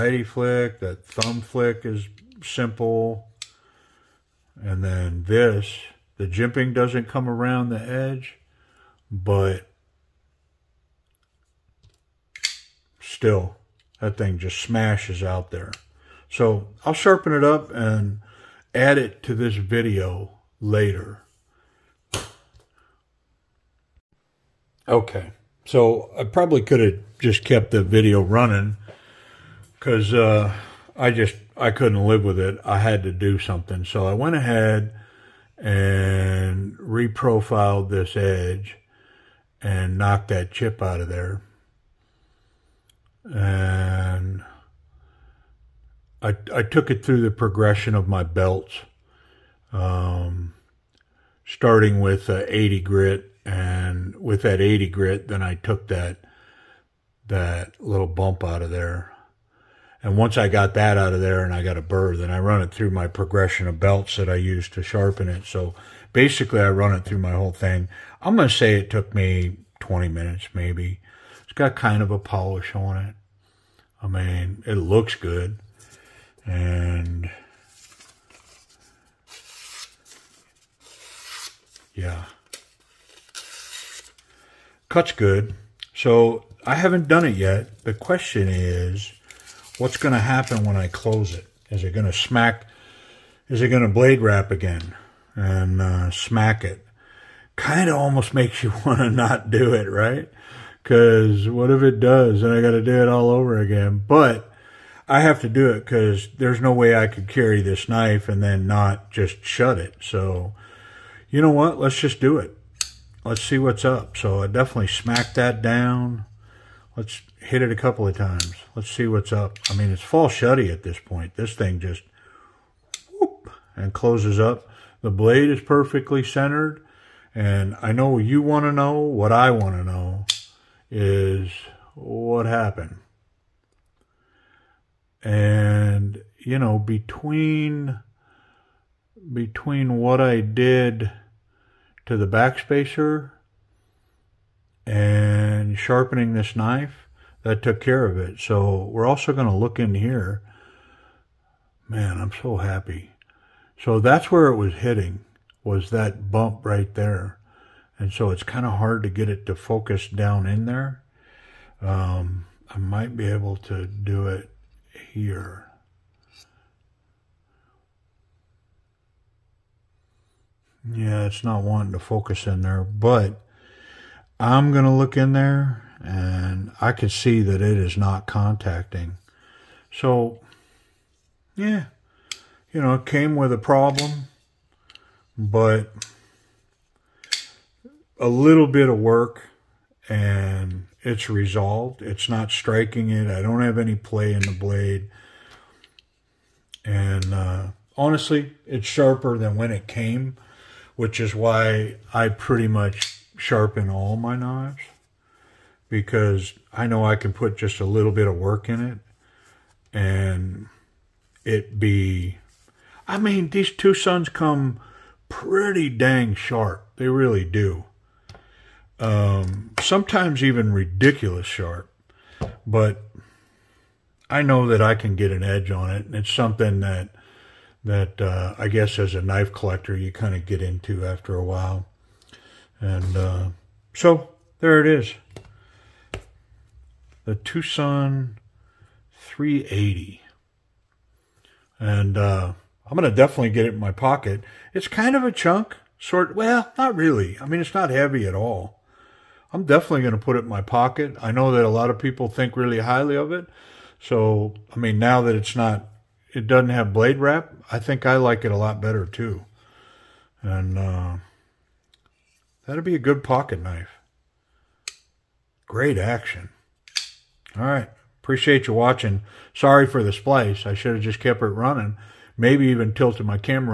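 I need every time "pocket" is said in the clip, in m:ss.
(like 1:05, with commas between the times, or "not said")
4:03, 4:10, 4:23.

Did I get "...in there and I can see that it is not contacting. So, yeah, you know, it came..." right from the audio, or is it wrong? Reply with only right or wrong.
right.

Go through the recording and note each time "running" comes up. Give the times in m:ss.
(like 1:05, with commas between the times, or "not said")
0:28, 4:31.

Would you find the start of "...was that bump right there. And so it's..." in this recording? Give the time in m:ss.
2:35.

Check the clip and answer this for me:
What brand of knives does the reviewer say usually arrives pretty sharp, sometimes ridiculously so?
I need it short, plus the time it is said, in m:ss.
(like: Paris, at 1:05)
TwoSun, at 3:33.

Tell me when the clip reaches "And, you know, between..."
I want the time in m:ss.
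2:15.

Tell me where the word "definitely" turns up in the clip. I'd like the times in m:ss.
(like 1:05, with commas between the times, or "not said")
1:54, 4:03, 4:09.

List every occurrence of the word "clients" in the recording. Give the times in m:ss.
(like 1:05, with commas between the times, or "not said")
not said.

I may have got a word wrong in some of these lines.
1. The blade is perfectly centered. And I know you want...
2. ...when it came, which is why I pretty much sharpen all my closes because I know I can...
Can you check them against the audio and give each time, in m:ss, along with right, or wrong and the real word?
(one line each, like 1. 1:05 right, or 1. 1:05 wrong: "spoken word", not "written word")
1. 2:05 right
2. 3:19 wrong: "knives", not "closes".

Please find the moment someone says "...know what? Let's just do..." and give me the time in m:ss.
1:51.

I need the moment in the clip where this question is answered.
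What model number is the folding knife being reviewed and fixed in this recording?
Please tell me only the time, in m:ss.
3:59.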